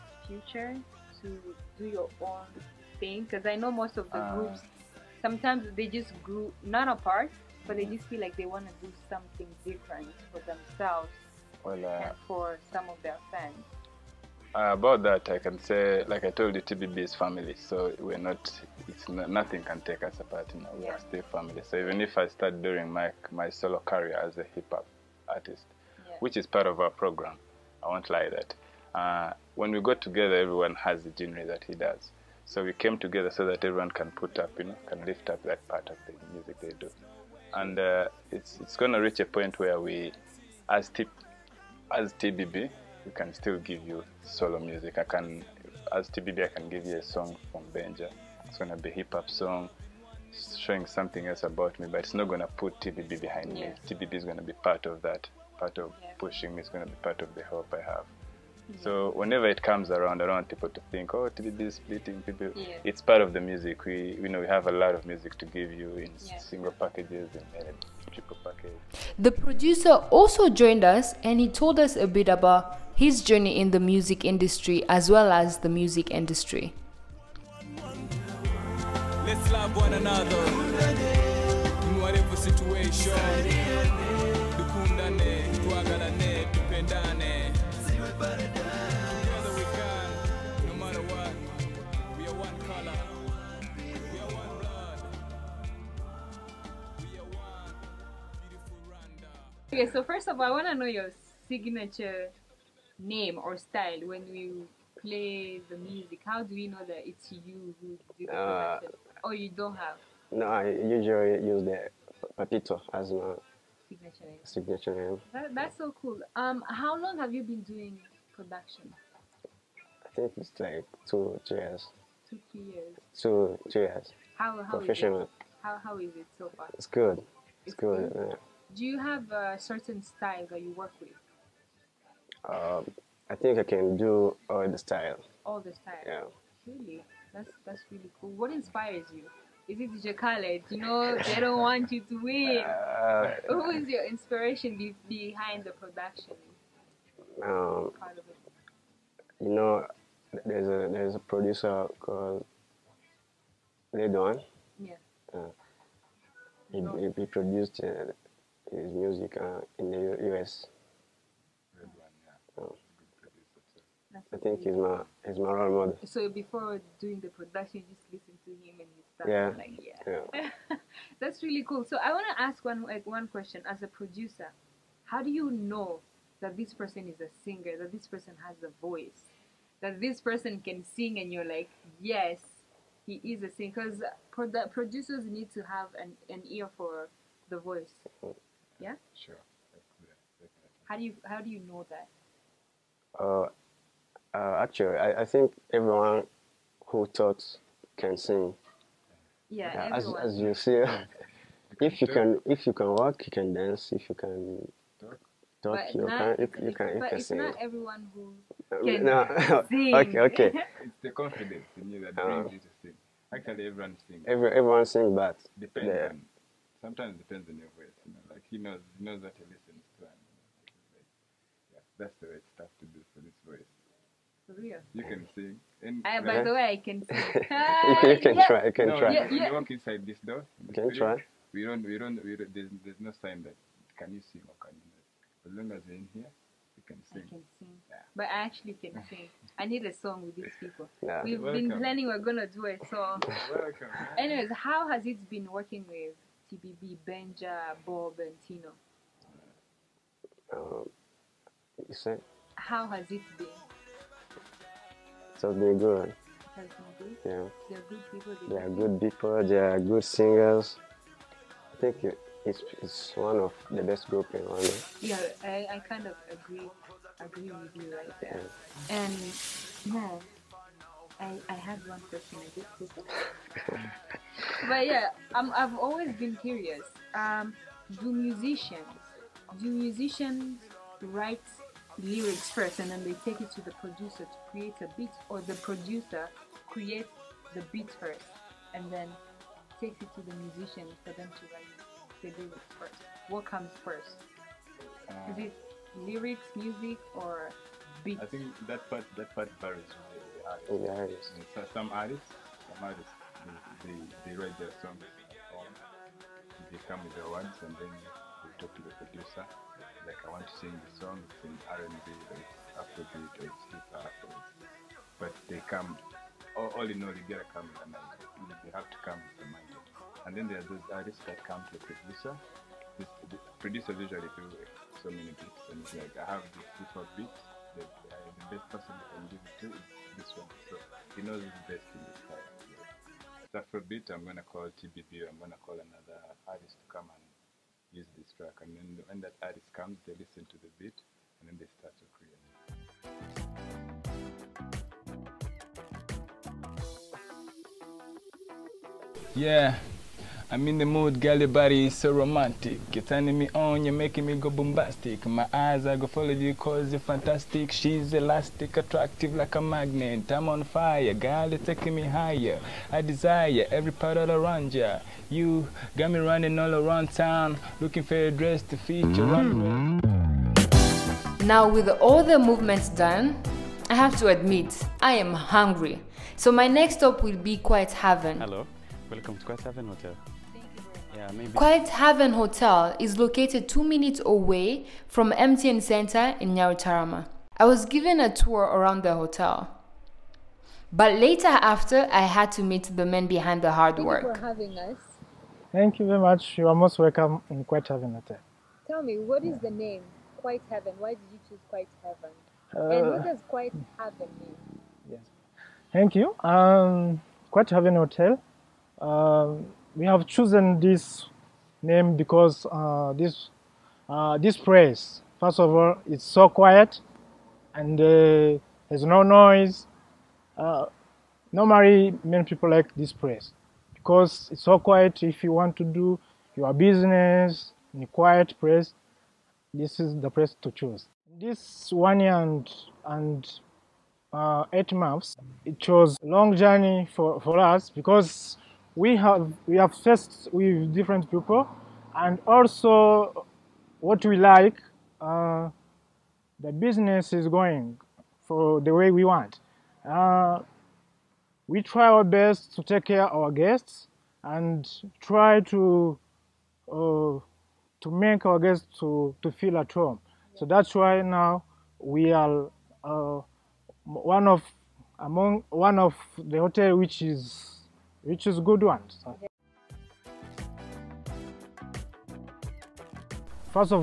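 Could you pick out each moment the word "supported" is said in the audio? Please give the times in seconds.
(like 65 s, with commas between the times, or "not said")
not said.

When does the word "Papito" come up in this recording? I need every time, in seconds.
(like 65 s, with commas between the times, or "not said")
112 s.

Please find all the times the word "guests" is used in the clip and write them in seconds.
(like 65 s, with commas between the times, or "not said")
453 s, 458 s.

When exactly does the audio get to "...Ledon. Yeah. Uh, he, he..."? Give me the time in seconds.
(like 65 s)
153 s.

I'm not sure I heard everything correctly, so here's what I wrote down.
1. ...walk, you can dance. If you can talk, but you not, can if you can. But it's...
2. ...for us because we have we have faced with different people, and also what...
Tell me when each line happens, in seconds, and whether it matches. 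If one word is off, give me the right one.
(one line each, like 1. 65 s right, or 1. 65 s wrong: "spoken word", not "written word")
1. 202 s right
2. 437 s right.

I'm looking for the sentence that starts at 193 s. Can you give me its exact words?
Uh, uh, actually, I, I think everyone who taught can sing.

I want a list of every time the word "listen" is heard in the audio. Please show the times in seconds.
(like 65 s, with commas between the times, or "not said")
168 s, 219 s, 340 s.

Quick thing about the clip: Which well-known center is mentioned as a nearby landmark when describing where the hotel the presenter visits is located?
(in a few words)
MTN Center.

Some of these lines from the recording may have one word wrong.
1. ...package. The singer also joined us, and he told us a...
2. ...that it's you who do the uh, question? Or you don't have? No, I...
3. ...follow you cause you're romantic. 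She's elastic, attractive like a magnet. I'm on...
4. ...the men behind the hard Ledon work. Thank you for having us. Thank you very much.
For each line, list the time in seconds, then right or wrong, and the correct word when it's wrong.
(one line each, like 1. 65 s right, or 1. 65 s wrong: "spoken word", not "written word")
1. 68 s wrong: "producer", not "singer"
2. 106 s wrong: "production", not "question"
3. 356 s wrong: "fantastic", not "romantic"
4. 392 s wrong: "Thank", not "Ledon".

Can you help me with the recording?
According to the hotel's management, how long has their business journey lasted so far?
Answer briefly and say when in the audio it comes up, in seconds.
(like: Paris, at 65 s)
1 year and 8 months, at 431 s.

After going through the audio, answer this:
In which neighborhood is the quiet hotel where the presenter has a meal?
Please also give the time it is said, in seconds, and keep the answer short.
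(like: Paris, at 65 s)
Nyarutarama, at 386 s.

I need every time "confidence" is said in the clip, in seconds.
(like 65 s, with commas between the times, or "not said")
211 s.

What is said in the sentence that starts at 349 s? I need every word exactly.
Yeah, I'm in the mood, girl, body is so romantic.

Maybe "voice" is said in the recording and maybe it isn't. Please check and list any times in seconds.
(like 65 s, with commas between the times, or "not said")
178 s, 187 s, 217 s, 223 s.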